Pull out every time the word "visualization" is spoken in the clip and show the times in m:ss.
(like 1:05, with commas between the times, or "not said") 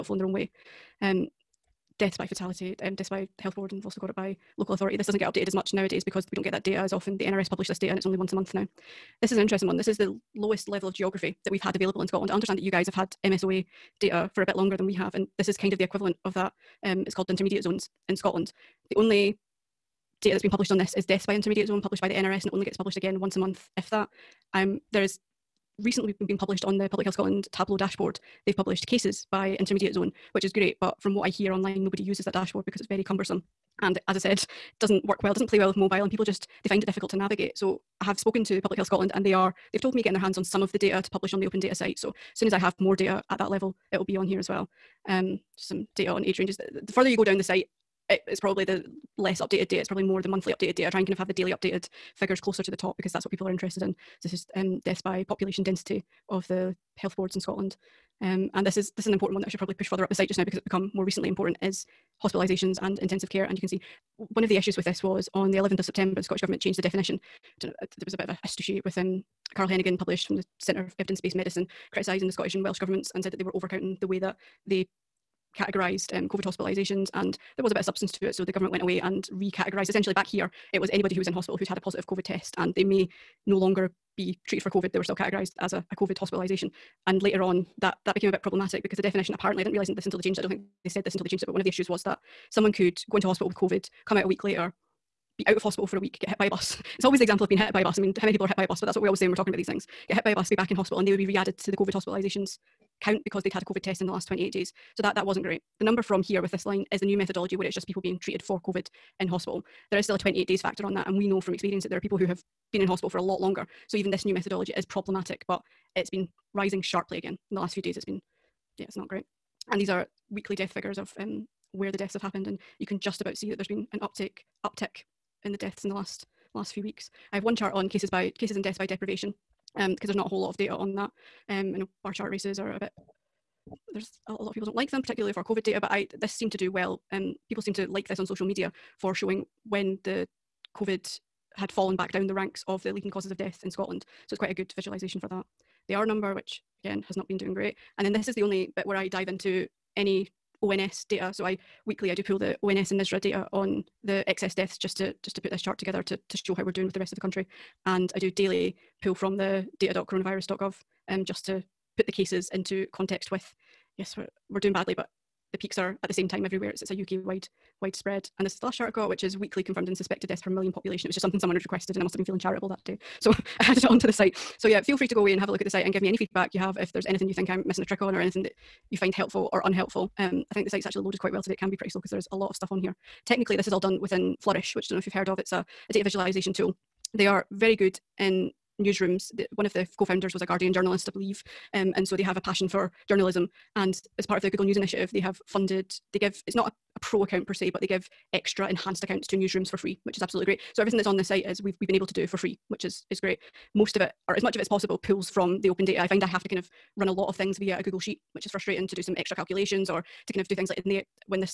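2:24, 3:06.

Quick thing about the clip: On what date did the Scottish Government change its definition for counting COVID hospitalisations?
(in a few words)
11th of September.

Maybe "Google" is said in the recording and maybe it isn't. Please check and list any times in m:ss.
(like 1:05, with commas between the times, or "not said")
3:14, 3:27.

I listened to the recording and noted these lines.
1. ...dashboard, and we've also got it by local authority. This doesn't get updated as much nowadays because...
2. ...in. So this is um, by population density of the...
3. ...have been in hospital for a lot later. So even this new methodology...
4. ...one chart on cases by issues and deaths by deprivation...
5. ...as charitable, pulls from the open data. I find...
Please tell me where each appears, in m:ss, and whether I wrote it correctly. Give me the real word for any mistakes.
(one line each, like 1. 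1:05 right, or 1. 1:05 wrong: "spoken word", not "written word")
1. 0:03 wrong: "board", not "dashboard"
2. 0:53 right
3. 1:52 wrong: "longer", not "later"
4. 2:07 wrong: "cases", not "issues"
5. 3:24 wrong: "possible", not "charitable".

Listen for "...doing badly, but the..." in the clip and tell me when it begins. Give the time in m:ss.
2:44.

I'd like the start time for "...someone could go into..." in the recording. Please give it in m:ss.
1:32.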